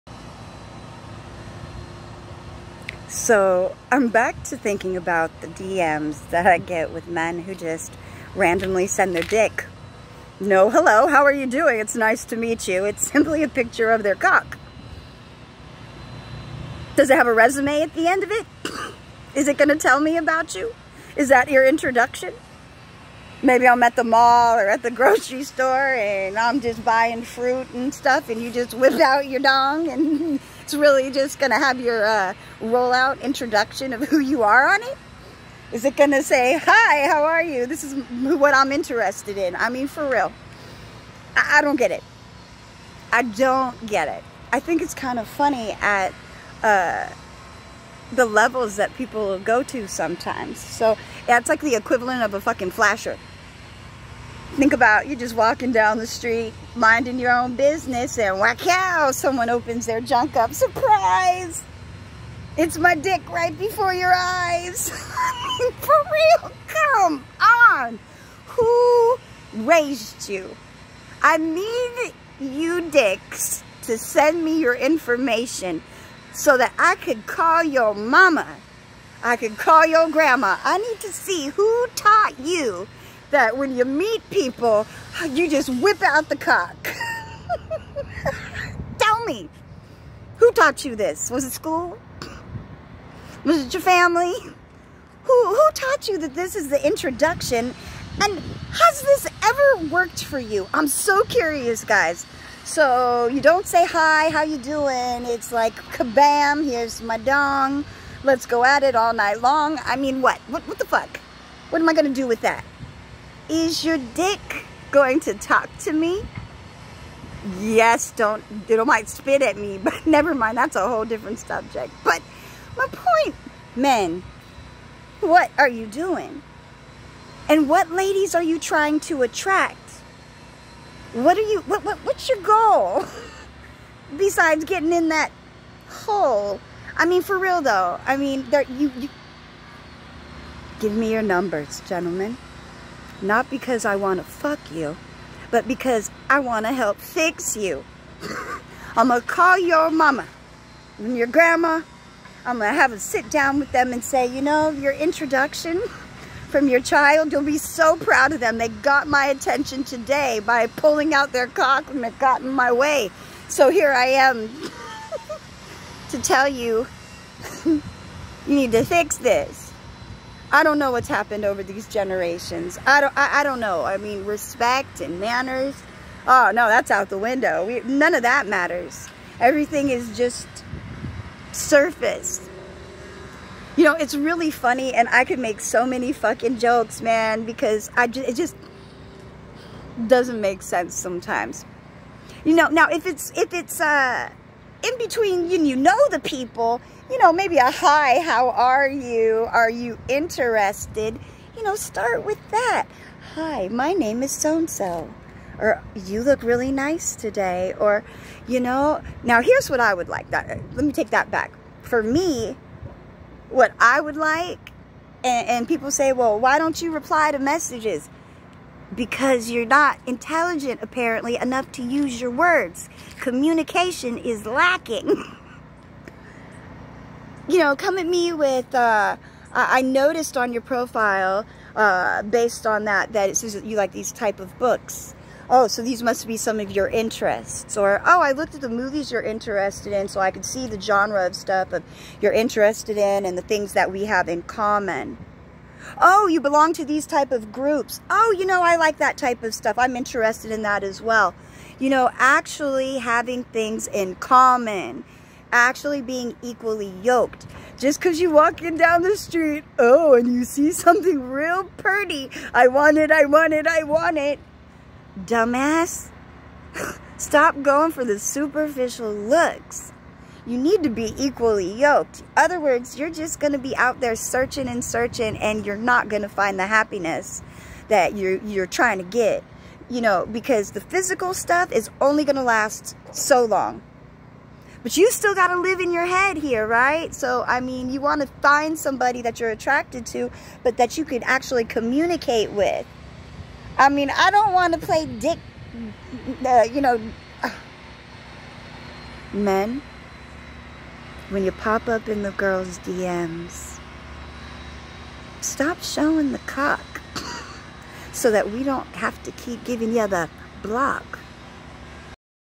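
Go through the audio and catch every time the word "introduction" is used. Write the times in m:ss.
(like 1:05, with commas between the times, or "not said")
0:21, 0:33, 1:36, 2:34.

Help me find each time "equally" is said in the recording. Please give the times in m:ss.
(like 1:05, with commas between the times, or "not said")
4:16, 4:31.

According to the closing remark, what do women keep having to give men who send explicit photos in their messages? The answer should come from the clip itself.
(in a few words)
the block.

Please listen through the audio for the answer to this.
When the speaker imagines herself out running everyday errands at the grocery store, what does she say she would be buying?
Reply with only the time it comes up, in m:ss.
0:27.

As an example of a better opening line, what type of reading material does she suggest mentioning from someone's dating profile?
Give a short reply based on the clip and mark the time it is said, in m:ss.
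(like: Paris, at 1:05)
books, at 3:54.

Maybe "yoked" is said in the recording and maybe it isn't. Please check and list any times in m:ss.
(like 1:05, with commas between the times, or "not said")
4:17, 4:31.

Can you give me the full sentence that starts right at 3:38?
because you're not intelligent apparently enough to use your words.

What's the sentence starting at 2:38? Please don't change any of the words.
They got my attention today by pulling out their cock and it got in my way.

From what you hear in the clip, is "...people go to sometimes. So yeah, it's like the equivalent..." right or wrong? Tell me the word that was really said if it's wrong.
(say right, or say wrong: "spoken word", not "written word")
right.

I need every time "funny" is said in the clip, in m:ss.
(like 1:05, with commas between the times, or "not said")
0:45, 3:04.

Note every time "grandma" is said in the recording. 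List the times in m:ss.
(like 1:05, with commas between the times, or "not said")
1:20, 2:31.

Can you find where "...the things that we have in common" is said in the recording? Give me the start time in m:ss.
4:03.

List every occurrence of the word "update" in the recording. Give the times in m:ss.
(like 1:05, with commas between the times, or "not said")
not said.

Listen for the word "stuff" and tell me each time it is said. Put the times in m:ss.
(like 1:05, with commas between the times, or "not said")
0:27, 4:01, 4:09, 4:41.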